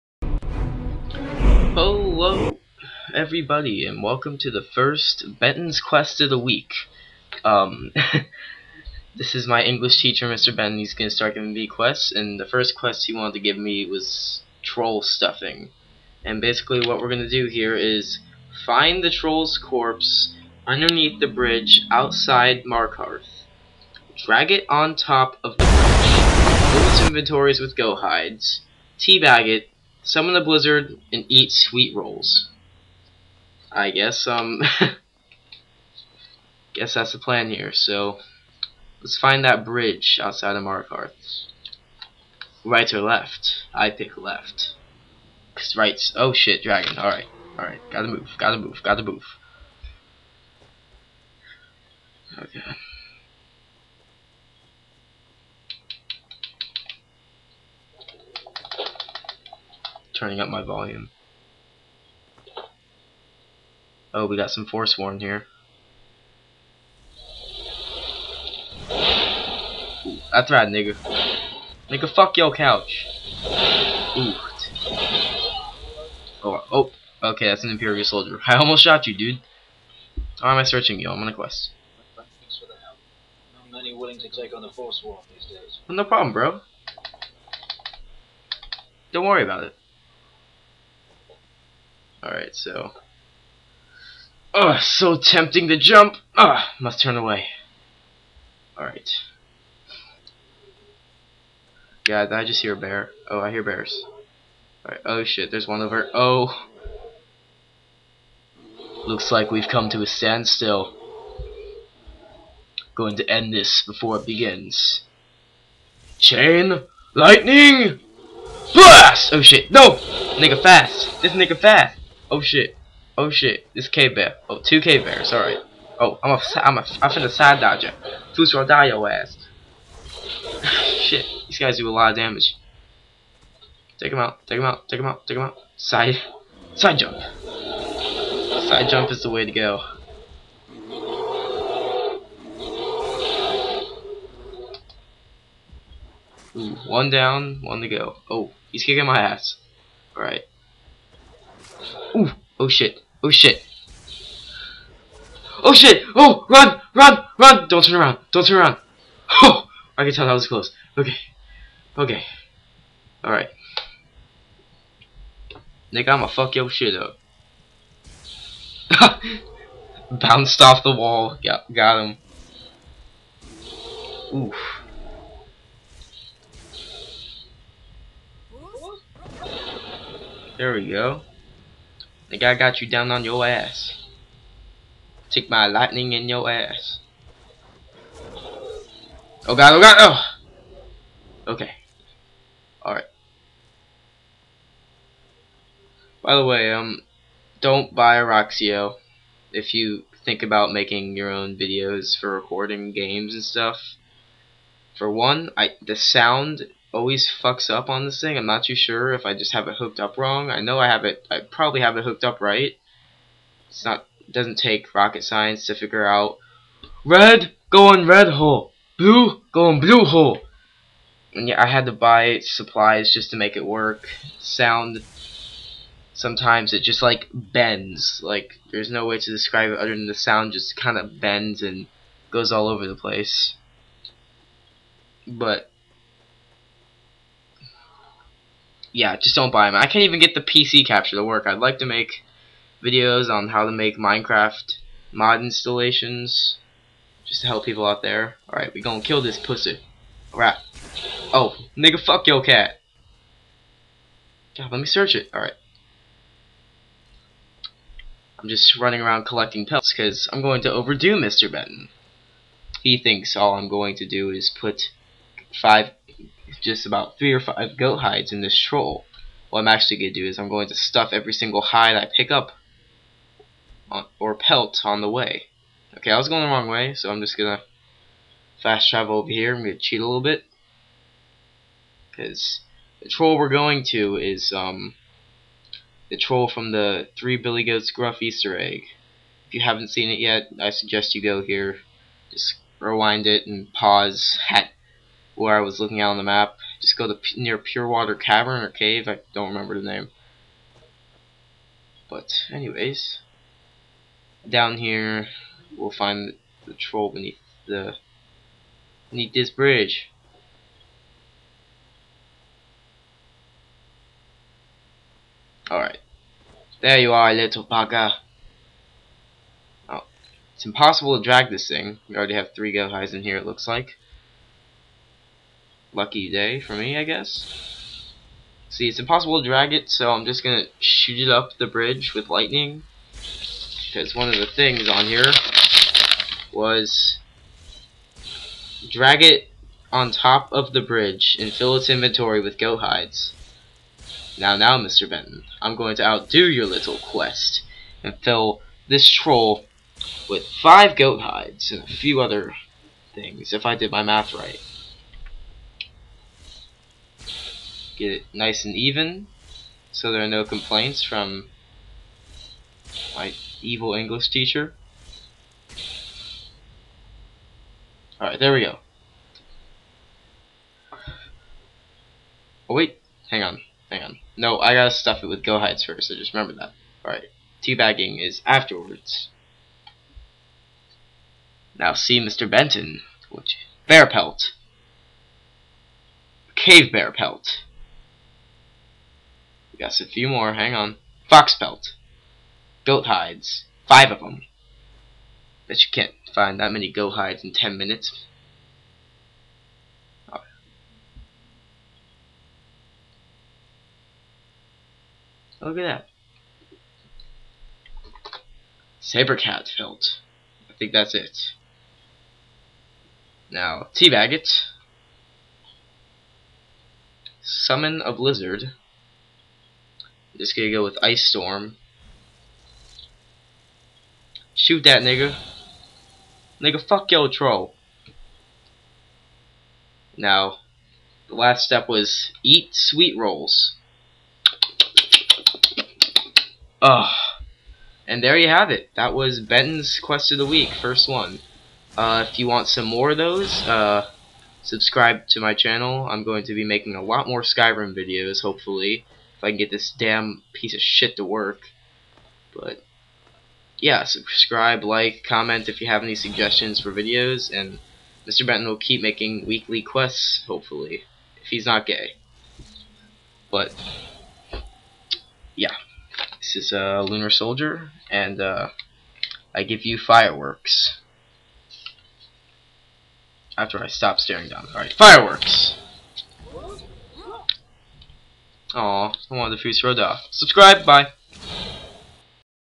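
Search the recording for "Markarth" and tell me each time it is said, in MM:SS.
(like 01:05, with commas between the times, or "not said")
00:22, 00:40.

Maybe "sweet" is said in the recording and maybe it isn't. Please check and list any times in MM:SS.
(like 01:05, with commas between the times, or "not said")
00:31, 07:12.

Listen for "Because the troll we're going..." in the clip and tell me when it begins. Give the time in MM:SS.
04:42.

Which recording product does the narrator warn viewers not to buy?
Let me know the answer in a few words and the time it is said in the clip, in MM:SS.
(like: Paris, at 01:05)
Roxio, at 03:18.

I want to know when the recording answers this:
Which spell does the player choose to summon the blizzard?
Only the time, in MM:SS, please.
07:01.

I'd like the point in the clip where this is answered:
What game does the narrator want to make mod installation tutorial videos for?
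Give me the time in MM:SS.
04:03.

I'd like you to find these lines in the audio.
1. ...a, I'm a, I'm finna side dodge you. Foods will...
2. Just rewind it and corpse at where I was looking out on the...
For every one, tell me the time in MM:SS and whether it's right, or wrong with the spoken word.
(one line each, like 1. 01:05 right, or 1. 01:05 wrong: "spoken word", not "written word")
1. 02:06 right
2. 04:52 wrong: "pause", not "corpse".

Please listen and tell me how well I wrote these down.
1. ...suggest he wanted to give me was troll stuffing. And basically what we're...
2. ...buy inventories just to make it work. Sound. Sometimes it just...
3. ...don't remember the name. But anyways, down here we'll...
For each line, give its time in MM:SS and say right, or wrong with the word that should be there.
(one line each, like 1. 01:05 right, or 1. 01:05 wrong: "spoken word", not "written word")
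1. 00:12 wrong: "quest", not "suggest"
2. 03:41 wrong: "supplies", not "inventories"
3. 04:59 right.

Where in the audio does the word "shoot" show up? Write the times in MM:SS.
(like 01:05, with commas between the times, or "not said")
05:30, 07:04.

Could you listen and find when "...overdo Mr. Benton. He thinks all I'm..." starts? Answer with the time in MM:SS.
04:20.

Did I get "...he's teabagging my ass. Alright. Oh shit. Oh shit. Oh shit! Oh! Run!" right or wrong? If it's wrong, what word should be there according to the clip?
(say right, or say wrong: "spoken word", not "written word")
wrong: "kicking", not "teabagging".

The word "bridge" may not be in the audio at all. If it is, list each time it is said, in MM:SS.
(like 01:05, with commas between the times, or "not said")
00:21, 00:25, 00:39, 05:09, 05:31, 05:40.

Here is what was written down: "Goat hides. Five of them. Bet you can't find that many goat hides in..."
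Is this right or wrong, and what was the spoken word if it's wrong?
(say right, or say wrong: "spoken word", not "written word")
right.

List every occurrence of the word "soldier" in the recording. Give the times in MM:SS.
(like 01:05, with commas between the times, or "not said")
01:18, 07:47.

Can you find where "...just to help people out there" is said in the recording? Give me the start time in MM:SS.
04:07.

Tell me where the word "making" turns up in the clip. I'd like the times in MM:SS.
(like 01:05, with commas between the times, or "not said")
03:20, 07:26, 07:39.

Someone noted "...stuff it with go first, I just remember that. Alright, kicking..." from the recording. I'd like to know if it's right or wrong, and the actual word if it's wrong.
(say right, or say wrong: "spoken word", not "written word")
wrong: "teabagging", not "kicking".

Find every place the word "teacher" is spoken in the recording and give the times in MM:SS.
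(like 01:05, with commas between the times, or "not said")
00:10, 06:04.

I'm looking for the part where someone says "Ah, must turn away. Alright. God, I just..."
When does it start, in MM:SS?
01:36.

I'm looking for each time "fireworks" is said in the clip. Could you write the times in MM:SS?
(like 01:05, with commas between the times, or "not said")
07:49, 07:54.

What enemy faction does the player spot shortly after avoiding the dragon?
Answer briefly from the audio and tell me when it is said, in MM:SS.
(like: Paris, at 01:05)
Forsworn, at 01:04.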